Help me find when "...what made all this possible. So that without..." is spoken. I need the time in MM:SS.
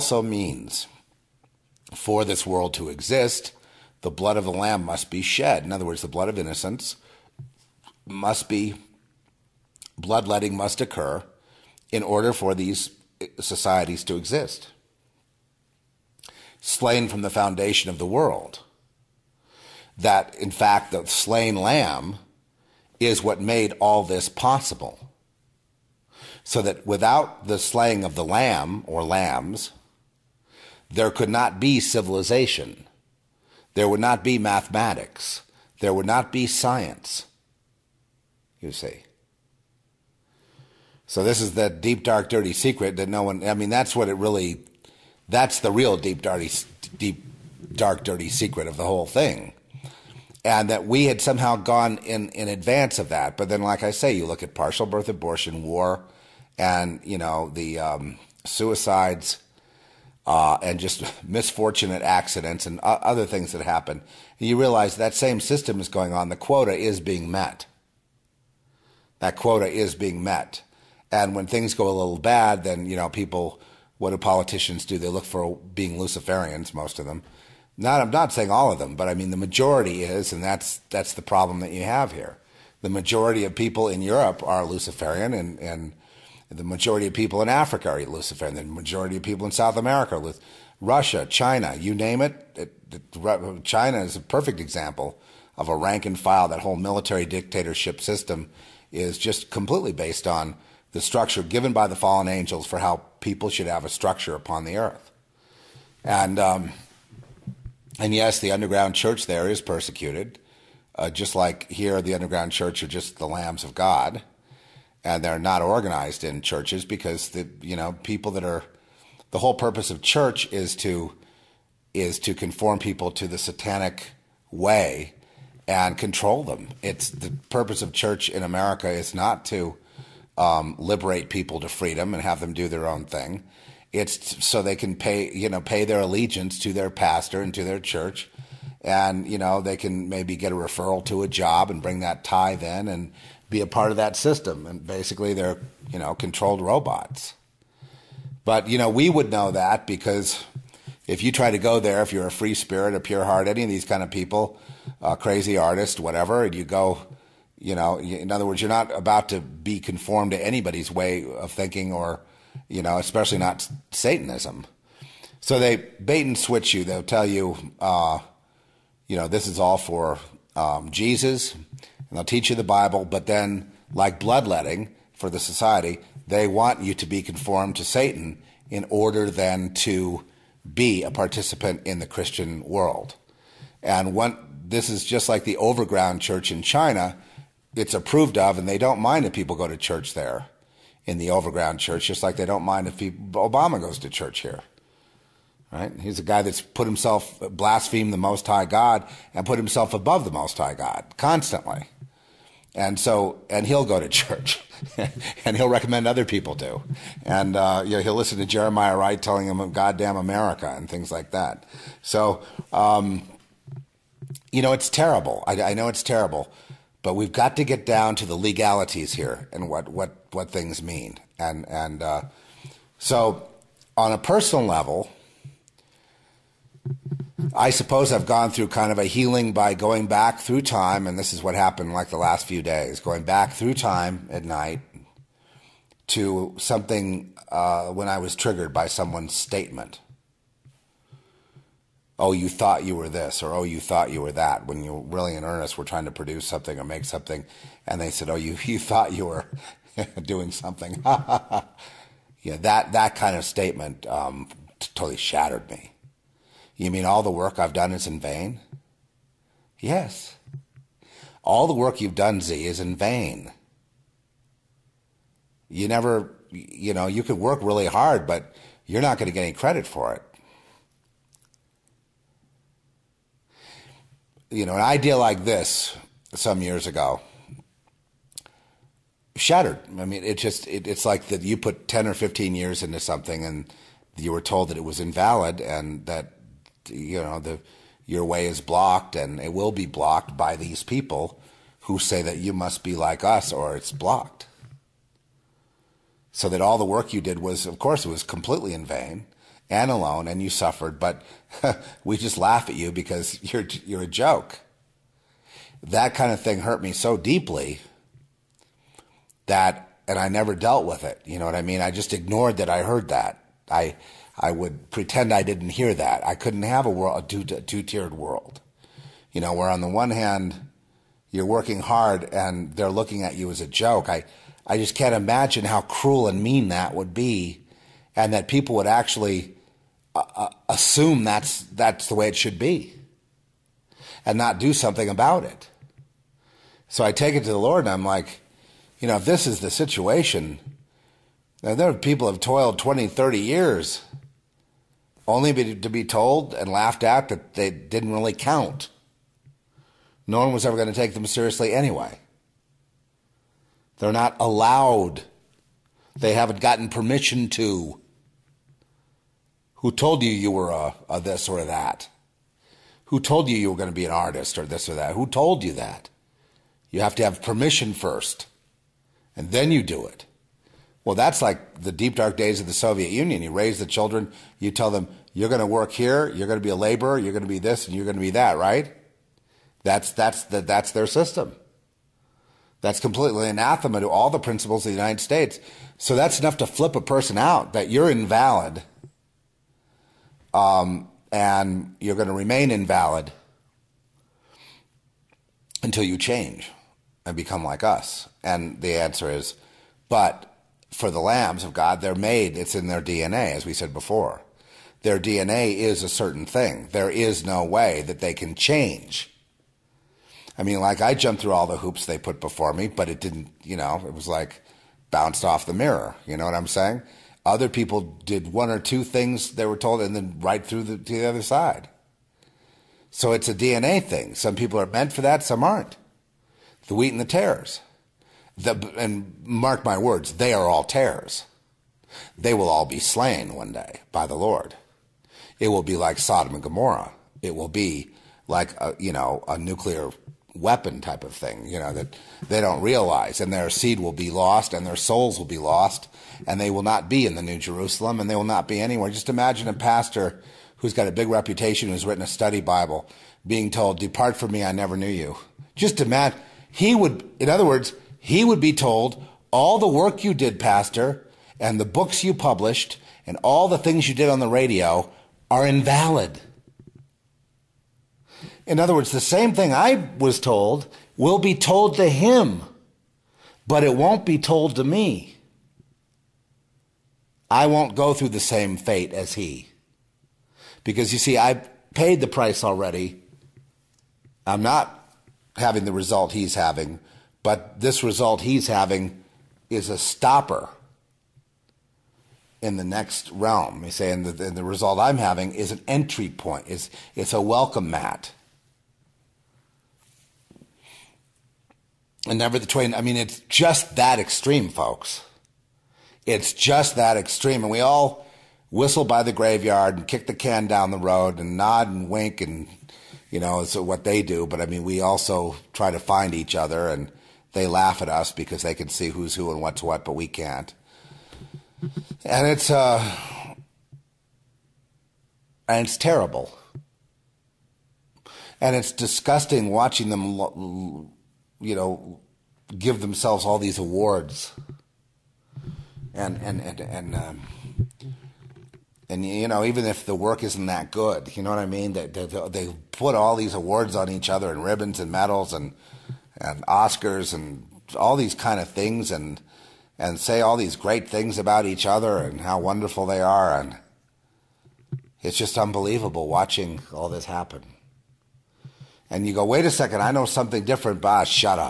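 00:23.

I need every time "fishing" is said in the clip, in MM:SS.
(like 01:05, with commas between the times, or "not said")
not said.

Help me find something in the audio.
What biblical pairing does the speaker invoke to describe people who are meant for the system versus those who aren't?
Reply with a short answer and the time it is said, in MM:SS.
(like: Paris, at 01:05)
The wheat and the tares, at 07:06.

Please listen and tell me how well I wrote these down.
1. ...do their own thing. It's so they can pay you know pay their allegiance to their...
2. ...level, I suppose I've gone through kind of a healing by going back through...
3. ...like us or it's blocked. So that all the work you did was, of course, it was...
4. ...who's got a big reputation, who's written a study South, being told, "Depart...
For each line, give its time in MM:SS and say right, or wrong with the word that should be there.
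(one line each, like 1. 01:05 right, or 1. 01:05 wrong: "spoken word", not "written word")
1. 02:12 right
2. 03:44 right
3. 04:52 right
4. 07:30 wrong: "Bible", not "South".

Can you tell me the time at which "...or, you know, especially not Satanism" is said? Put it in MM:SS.
02:41.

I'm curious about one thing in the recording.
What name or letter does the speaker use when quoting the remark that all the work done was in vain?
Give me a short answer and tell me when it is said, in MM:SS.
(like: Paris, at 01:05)
Z, at 04:22.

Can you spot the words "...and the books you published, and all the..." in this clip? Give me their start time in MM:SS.
07:41.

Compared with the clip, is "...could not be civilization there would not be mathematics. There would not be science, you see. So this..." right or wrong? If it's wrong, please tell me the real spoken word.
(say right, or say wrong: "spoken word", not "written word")
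right.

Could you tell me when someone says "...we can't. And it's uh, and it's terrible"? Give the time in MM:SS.
08:40.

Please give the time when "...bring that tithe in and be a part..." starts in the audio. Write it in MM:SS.
02:21.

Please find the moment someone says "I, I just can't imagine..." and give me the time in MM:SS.
05:24.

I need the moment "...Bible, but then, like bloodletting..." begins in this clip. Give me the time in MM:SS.
02:52.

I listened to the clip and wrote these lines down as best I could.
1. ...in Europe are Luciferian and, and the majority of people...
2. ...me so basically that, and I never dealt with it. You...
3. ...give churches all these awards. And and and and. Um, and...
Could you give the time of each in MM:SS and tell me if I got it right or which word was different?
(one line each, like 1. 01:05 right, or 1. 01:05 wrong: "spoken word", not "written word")
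1. 01:23 right
2. 05:06 wrong: "deeply", not "basically"
3. 08:52 wrong: "themselves", not "churches".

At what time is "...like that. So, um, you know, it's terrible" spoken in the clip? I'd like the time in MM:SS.
03:31.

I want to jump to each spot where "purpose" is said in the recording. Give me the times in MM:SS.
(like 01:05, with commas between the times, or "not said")
01:59, 02:07.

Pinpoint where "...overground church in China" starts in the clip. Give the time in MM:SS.
03:05.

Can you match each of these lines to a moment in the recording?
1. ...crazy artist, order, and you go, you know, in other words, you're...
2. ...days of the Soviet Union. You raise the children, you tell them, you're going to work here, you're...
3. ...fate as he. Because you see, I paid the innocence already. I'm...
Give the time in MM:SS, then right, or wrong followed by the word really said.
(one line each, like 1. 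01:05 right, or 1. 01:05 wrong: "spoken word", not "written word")
1. 02:35 wrong: "whatever", not "order"
2. 06:12 right
3. 07:58 wrong: "price", not "innocence".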